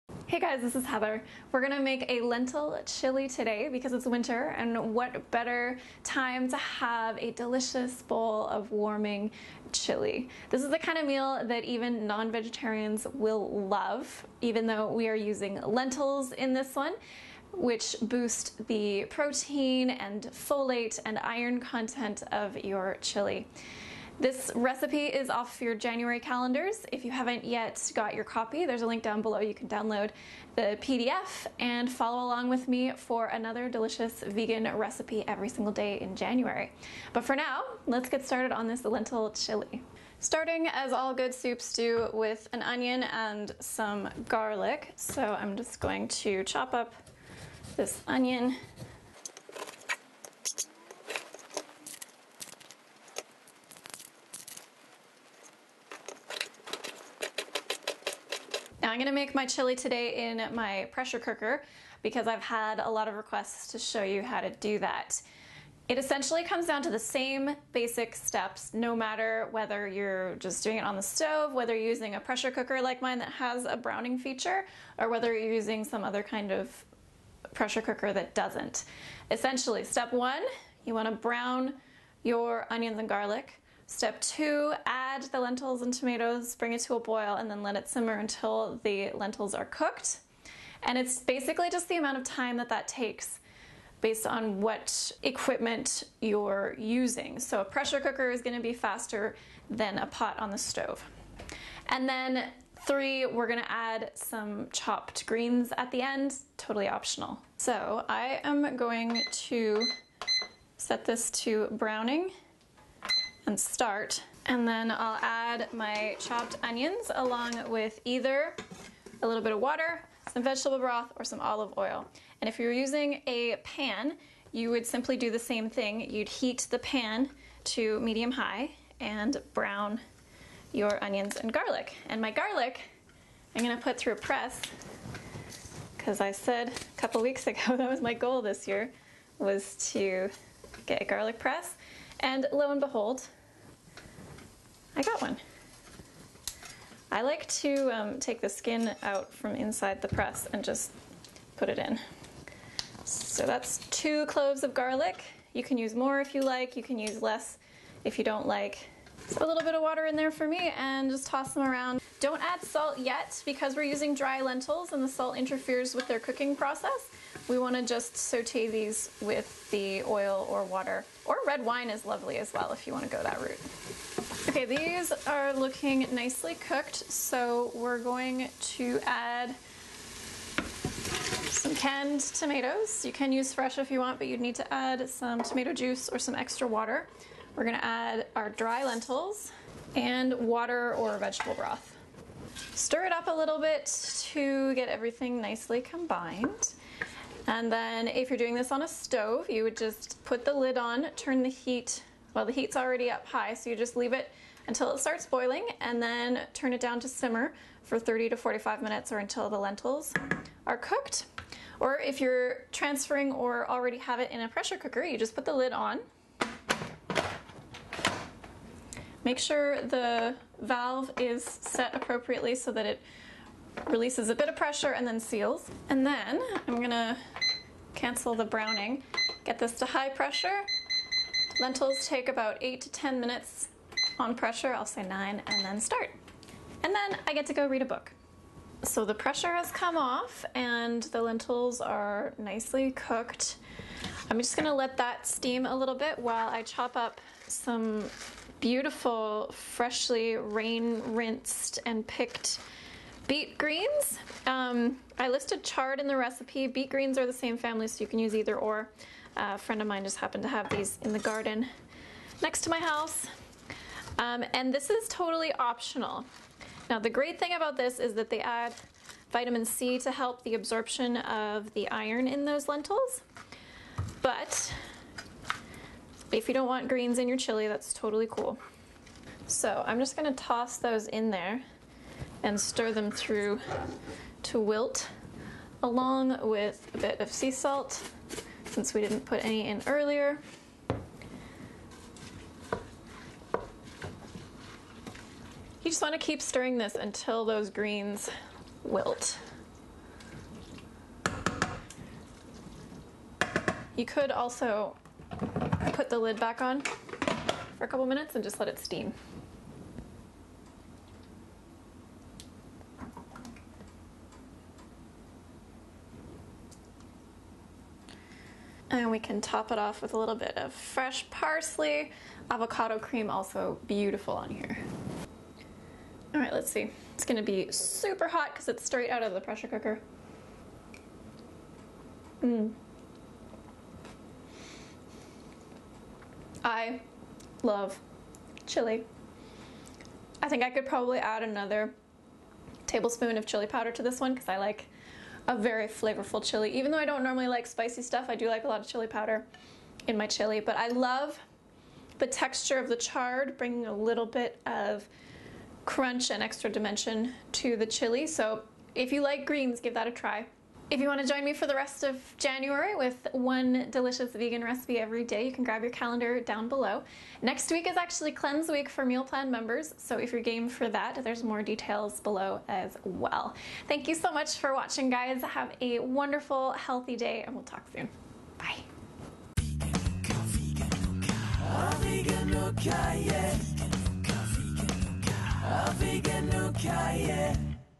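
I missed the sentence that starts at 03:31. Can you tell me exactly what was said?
Or if you're transferring or already have it in a pressure cooker, you just put the lid on.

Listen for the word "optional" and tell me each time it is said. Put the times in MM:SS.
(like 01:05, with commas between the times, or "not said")
01:46, 04:25.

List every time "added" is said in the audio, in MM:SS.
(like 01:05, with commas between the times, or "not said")
not said.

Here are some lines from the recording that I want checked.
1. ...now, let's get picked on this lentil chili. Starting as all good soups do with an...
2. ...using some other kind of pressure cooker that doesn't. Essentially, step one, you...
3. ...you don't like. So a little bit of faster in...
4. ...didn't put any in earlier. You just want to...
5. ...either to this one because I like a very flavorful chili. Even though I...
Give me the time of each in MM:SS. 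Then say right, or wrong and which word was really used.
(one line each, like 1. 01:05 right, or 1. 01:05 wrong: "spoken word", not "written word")
1. 00:37 wrong: "started", not "picked"
2. 01:15 right
3. 02:38 wrong: "water", not "faster"
4. 04:49 right
5. 05:43 wrong: "powder", not "either".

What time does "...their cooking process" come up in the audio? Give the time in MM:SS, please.
02:46.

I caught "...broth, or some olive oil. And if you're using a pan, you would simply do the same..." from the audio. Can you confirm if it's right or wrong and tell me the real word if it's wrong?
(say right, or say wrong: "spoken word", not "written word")
right.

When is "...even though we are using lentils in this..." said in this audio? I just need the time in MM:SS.
00:14.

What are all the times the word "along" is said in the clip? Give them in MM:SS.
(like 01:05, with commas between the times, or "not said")
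00:32, 01:57, 04:45.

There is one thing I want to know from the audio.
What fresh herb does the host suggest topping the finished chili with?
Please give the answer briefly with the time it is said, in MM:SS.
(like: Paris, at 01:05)
parsley, at 05:21.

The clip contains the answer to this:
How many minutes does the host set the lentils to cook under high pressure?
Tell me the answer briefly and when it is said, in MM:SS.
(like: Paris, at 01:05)
9, at 03:55.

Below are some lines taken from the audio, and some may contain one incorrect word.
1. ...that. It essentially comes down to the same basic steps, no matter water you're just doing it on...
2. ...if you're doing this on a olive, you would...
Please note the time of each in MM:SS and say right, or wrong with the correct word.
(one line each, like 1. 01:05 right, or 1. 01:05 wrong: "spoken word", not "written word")
1. 01:04 wrong: "whether", not "water"
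2. 03:18 wrong: "stove", not "olive".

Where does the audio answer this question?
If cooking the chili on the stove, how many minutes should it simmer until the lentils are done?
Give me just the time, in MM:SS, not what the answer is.
03:27.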